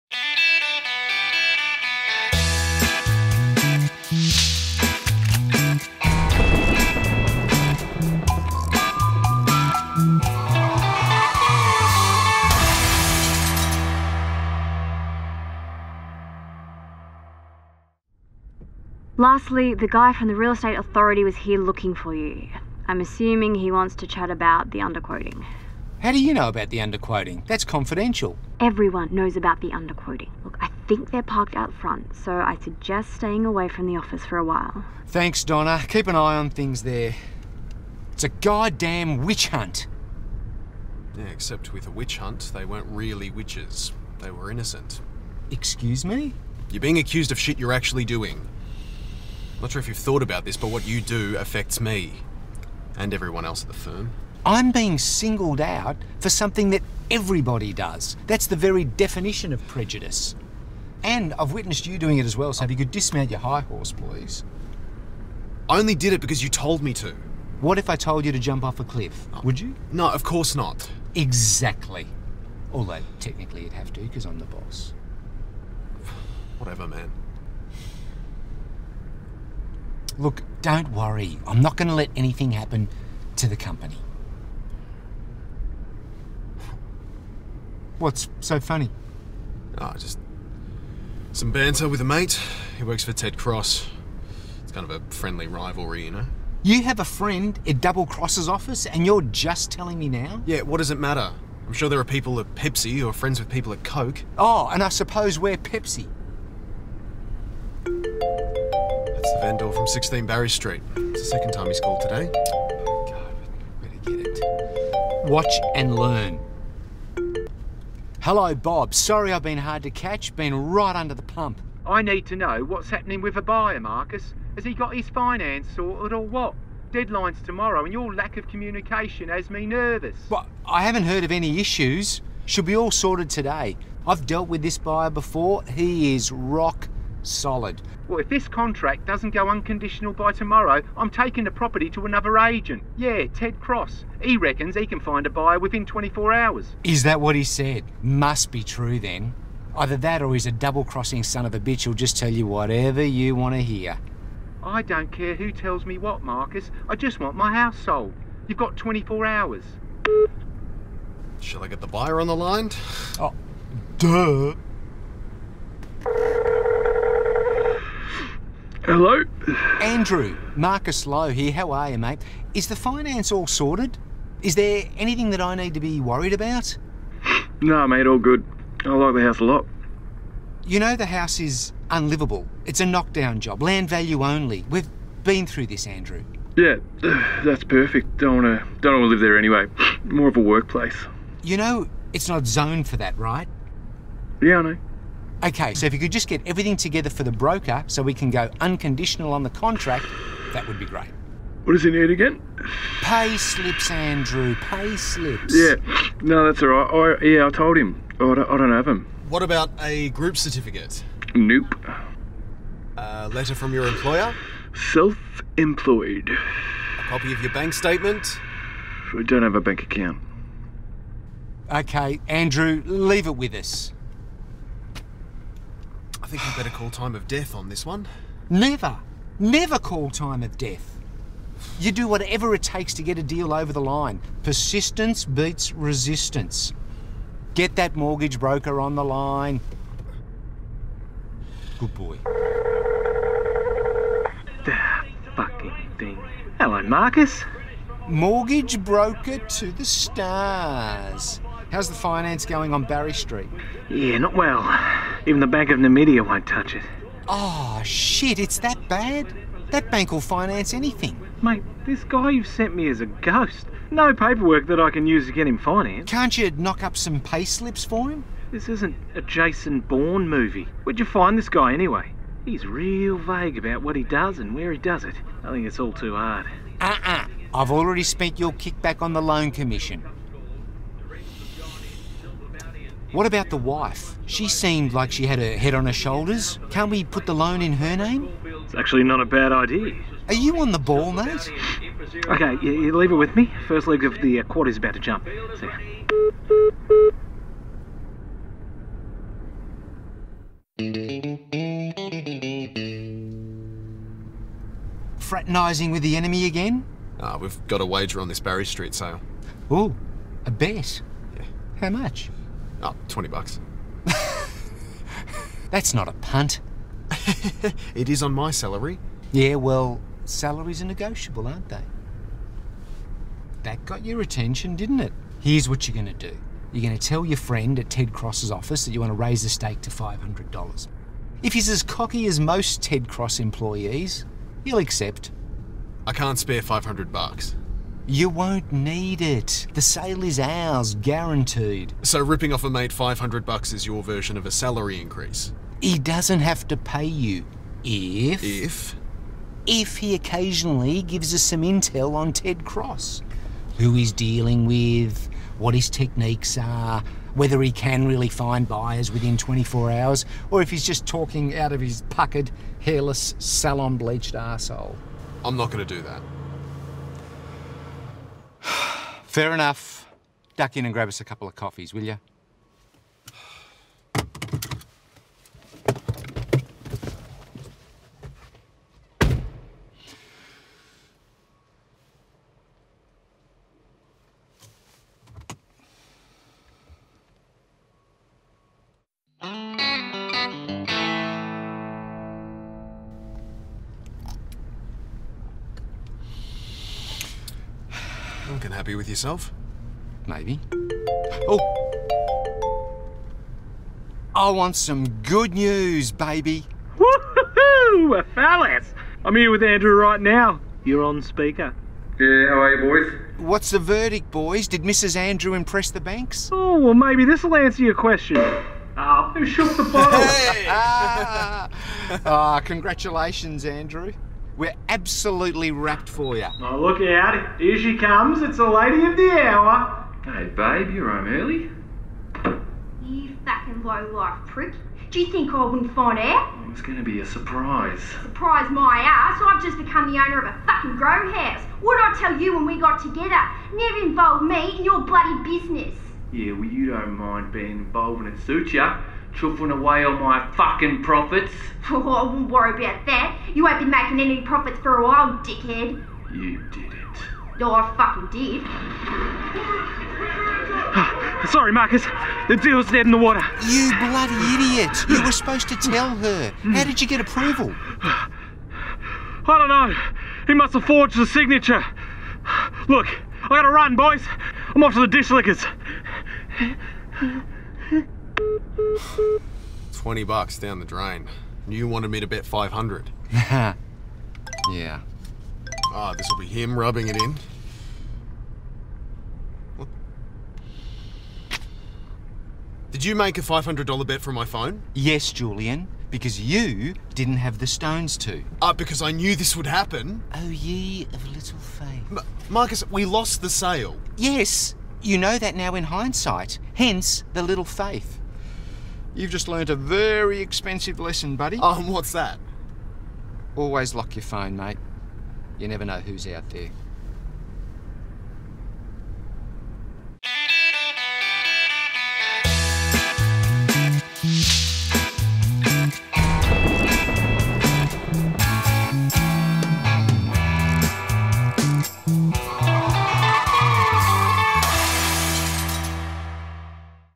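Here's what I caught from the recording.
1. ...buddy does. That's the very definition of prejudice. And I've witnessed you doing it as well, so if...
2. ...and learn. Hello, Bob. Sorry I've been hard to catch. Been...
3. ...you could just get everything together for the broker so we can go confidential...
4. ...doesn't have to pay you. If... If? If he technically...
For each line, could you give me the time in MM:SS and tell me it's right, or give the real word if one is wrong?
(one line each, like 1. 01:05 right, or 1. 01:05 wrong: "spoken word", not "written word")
1. 00:57 wrong: "everybody", not "buddy"
2. 01:55 right
3. 03:15 wrong: "unconditional", not "confidential"
4. 05:45 wrong: "occasionally", not "technically".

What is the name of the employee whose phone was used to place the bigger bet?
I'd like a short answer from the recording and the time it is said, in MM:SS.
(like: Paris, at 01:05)
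Julian, at 08:15.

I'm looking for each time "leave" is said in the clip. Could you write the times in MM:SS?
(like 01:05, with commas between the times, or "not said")
03:42, 04:52.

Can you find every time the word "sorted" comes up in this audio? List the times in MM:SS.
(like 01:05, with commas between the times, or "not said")
02:05, 02:12, 02:53.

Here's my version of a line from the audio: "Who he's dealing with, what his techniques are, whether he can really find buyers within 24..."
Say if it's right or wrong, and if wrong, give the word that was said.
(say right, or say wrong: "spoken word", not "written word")
right.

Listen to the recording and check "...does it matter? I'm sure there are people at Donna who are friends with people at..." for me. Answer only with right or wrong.
wrong.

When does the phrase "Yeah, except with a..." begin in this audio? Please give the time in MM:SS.
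00:41.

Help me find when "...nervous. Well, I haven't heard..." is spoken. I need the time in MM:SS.
02:09.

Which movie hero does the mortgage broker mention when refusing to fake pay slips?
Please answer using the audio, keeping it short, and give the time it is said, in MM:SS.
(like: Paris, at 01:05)
Jason Bourne, at 04:29.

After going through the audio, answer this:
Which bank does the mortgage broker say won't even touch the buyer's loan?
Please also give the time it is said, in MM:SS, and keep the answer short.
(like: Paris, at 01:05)
Bank of Namibia, at 04:15.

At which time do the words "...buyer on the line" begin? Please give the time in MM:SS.
02:41.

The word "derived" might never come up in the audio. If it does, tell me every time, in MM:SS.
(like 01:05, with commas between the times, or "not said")
not said.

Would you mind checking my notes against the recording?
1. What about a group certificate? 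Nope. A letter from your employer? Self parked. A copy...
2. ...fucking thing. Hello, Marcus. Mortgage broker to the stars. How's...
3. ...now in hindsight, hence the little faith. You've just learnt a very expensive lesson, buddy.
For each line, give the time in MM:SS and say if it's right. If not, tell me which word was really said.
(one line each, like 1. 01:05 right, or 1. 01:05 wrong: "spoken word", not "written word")
1. 03:29 wrong: "employed", not "parked"
2. 04:05 right
3. 08:25 right.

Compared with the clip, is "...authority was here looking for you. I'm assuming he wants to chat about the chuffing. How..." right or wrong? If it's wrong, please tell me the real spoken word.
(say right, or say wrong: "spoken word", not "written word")
wrong: "underquoting", not "chuffing".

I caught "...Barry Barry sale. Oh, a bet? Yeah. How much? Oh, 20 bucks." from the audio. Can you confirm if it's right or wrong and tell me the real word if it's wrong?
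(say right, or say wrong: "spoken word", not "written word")
wrong: "Street", not "Barry".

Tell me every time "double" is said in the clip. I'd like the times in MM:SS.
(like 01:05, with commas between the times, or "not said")
01:37, 02:30.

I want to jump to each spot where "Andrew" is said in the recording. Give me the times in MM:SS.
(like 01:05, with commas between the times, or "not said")
02:49, 03:05, 03:23, 03:42, 06:49, 06:55, 07:03.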